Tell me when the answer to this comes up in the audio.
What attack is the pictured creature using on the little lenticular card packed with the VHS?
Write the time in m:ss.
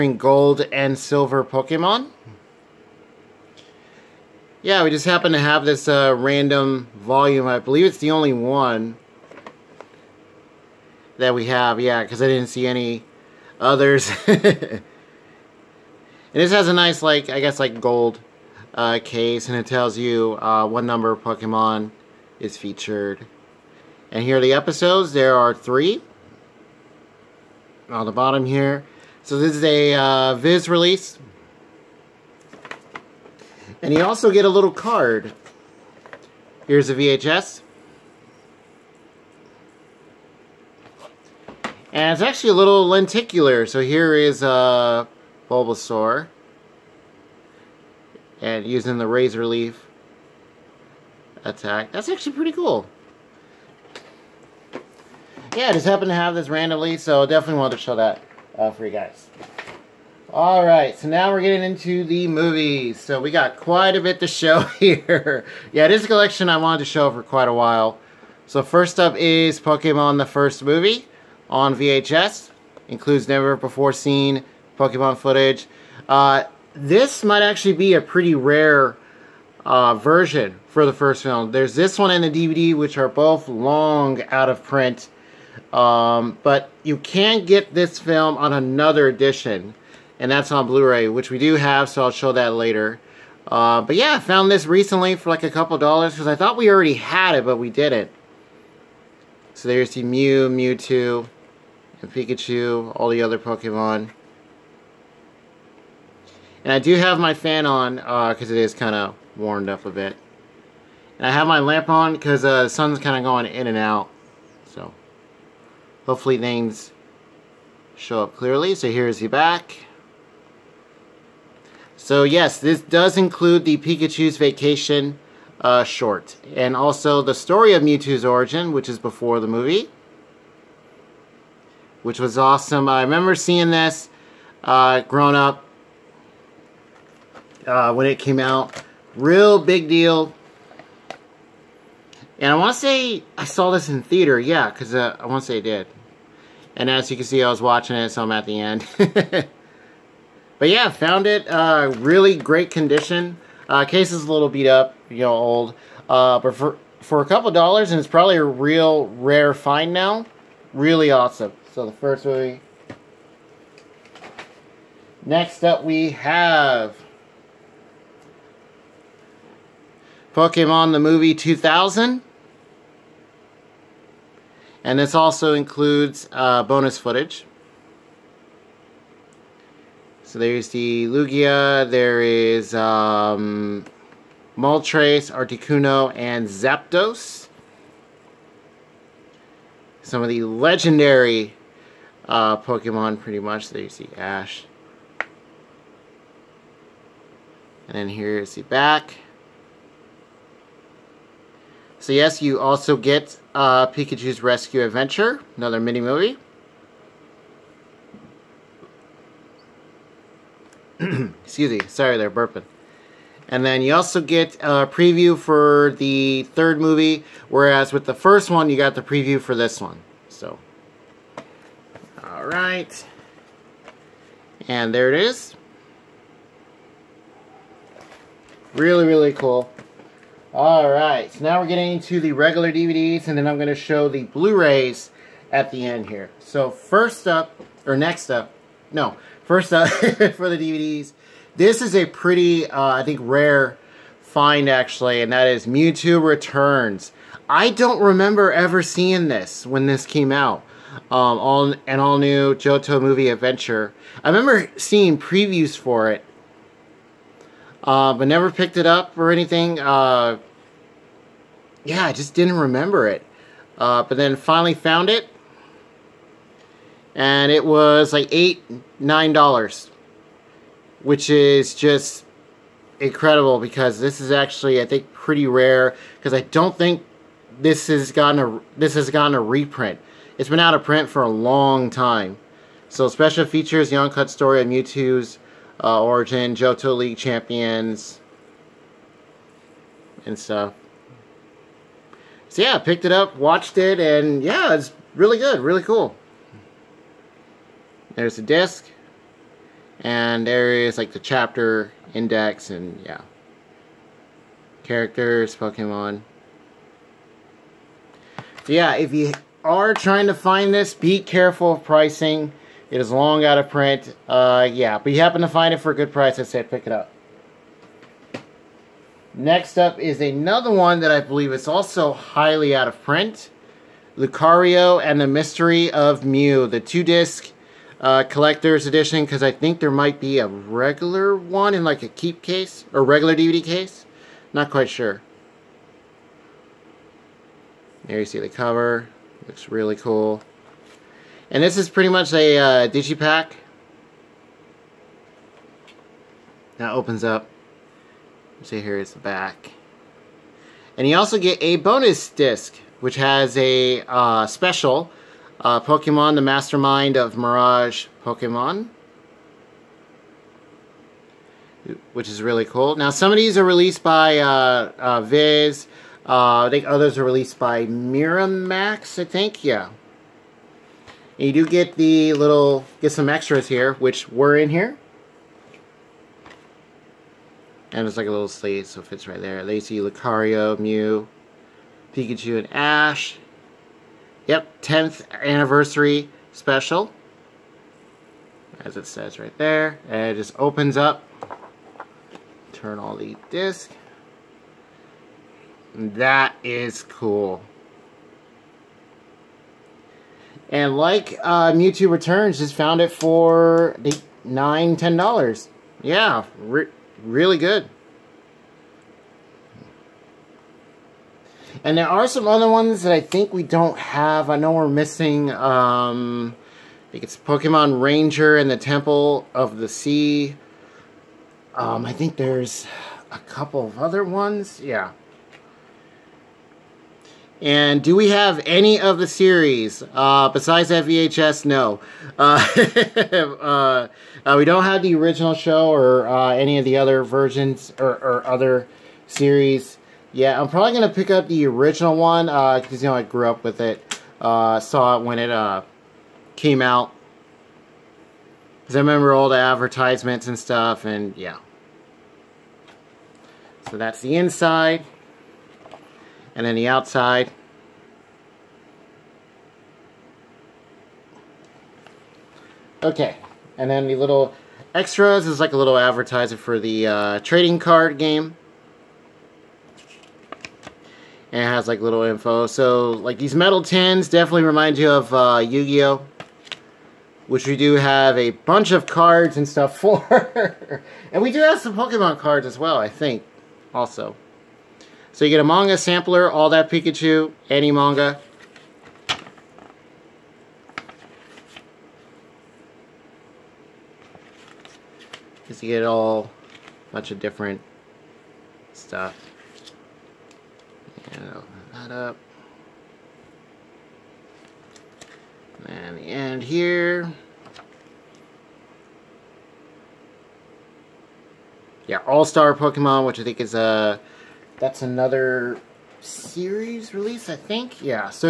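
0:49.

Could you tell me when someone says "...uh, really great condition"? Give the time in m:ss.
2:31.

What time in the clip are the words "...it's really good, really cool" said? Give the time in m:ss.
4:54.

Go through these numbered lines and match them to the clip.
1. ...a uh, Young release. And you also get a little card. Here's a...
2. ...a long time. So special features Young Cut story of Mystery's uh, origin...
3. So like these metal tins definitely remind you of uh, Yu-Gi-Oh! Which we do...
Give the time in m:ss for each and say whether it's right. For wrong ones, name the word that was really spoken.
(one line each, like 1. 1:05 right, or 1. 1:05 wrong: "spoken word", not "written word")
1. 0:29 wrong: "Viz", not "Young"
2. 4:41 wrong: "Mewtwo", not "Mystery"
3. 7:52 right.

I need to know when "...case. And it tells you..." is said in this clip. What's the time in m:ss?
0:19.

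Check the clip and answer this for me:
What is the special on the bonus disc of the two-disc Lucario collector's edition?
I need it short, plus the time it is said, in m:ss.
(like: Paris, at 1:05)
The Mastermind of Mirage Pokemon, at 5:56.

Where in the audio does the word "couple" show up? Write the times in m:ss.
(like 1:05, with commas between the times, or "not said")
1:35, 2:37, 7:03.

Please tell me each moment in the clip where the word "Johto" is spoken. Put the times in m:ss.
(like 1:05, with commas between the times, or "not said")
4:12, 4:46.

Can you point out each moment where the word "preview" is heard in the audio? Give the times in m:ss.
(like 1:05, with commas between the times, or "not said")
3:34, 3:39, 4:15.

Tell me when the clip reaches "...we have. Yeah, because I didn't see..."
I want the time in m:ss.
0:11.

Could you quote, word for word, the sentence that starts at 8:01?
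and we do have some Pokemon cards as well, I think, also.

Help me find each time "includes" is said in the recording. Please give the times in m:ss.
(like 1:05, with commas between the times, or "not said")
1:12, 2:03, 2:55.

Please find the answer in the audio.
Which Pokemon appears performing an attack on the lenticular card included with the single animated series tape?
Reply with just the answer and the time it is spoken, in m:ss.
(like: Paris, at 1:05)
Bulbasaur, at 0:45.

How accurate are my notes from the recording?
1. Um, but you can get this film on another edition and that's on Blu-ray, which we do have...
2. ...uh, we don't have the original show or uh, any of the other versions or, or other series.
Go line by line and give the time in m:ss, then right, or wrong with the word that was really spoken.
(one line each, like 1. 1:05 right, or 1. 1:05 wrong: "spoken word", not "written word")
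1. 1:25 right
2. 7:14 right.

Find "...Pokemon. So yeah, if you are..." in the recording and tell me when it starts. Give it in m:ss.
5:05.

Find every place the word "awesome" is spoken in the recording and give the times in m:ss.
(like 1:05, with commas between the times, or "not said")
2:12, 2:41.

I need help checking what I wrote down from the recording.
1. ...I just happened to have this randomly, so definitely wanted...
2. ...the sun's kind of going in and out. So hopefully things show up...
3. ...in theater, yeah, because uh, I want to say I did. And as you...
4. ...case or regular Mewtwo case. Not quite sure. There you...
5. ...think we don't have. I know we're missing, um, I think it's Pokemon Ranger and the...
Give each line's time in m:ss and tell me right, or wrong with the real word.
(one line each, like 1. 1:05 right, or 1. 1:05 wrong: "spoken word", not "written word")
1. 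0:55 right
2. 1:52 right
3. 2:23 right
4. 5:32 wrong: "DVD", not "Mewtwo"
5. 6:53 right.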